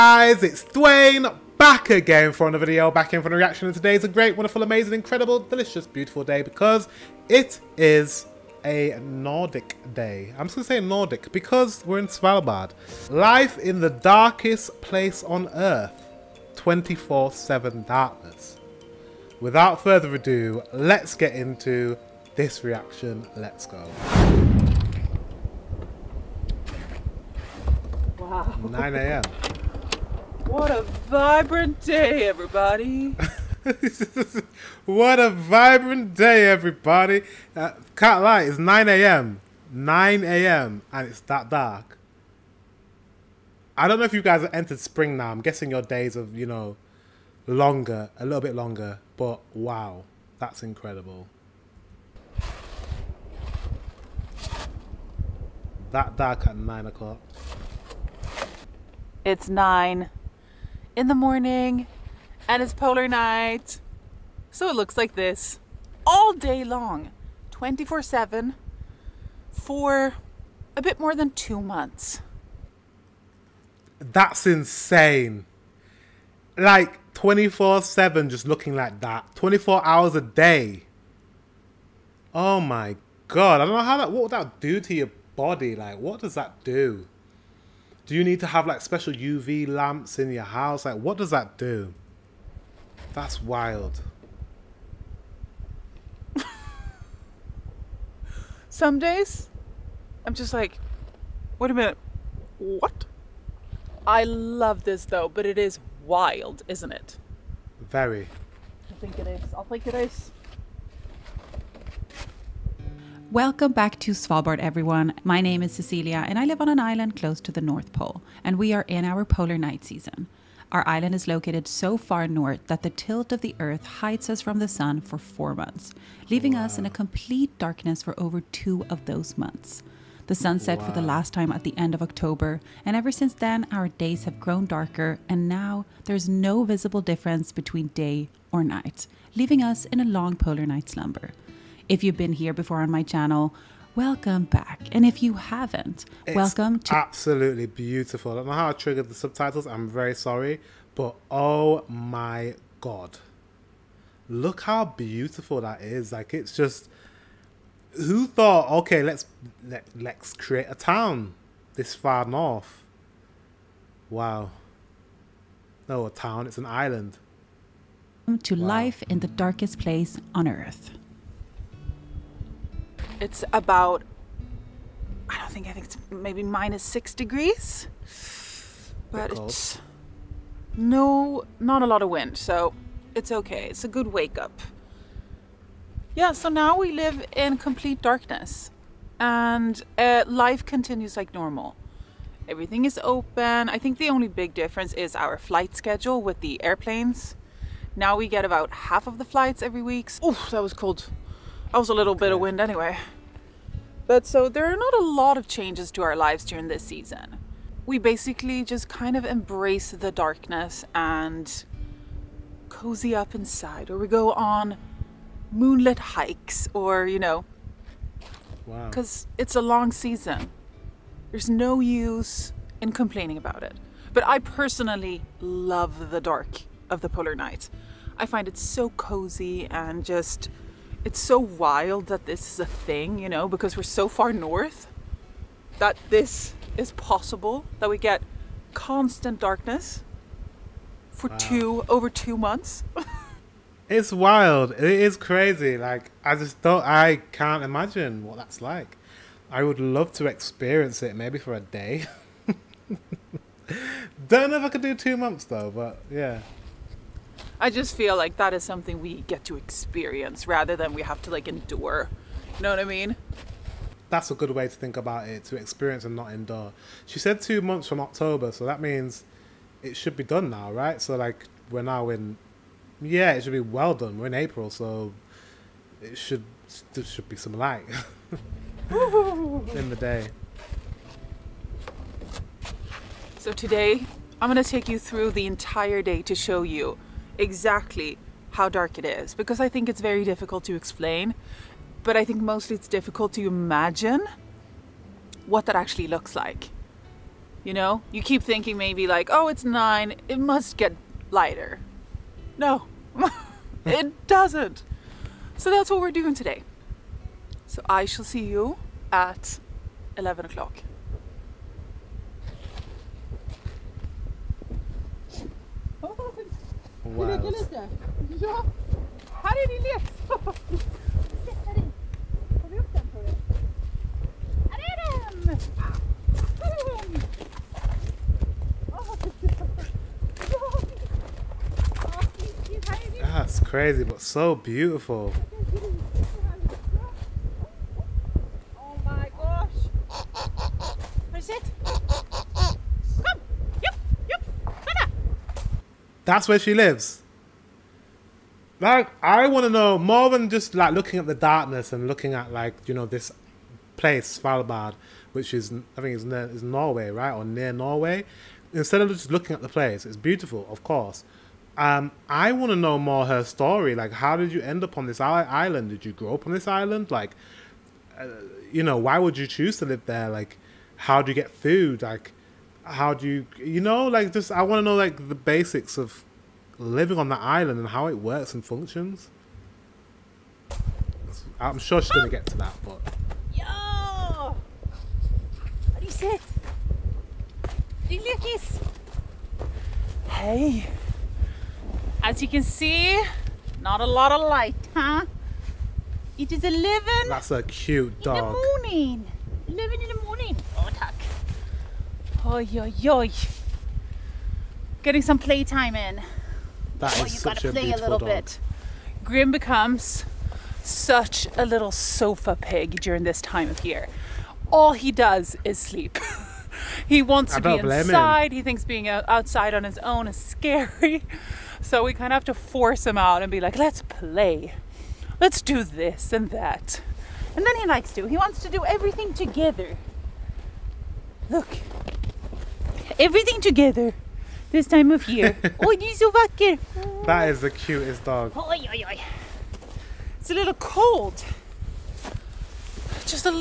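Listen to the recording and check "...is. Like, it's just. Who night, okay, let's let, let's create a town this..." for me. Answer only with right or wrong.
wrong.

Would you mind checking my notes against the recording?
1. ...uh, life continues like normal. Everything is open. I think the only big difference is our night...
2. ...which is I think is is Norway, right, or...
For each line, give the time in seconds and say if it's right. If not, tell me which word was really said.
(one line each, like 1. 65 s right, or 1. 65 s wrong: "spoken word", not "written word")
1. 189 s wrong: "flight", not "night"
2. 355 s right.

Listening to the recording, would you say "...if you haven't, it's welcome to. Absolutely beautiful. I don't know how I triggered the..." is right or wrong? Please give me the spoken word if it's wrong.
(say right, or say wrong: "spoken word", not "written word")
right.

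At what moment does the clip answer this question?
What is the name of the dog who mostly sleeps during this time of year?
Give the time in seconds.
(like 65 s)
409 s.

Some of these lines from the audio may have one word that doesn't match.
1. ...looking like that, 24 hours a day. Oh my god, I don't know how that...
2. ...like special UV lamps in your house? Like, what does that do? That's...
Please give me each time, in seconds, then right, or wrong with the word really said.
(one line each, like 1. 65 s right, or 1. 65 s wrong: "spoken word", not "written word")
1. 78 s right
2. 88 s right.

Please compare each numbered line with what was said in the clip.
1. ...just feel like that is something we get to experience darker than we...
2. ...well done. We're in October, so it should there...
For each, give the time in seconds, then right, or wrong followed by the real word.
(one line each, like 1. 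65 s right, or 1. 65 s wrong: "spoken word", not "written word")
1. 257 s wrong: "rather", not "darker"
2. 273 s wrong: "April", not "October".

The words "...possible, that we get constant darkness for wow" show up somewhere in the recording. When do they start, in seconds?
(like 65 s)
236 s.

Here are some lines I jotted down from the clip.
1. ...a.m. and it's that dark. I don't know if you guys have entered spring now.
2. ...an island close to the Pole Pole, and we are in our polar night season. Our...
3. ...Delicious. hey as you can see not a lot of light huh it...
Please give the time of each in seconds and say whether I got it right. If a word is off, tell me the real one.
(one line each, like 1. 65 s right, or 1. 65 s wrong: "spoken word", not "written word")
1. 40 s right
2. 116 s wrong: "North", not "Pole"
3. 388 s right.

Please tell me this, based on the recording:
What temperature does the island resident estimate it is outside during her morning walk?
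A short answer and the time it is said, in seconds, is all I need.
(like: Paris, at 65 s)
-6 degrees, at 176 s.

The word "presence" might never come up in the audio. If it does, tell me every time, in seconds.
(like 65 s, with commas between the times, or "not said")
not said.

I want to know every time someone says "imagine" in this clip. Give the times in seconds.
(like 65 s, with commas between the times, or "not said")
247 s, 293 s.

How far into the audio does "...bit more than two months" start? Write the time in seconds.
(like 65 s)
70 s.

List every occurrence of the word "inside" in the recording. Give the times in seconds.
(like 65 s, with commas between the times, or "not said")
213 s, 417 s.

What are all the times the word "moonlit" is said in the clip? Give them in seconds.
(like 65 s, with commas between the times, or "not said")
215 s.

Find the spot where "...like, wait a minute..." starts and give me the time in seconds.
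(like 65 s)
100 s.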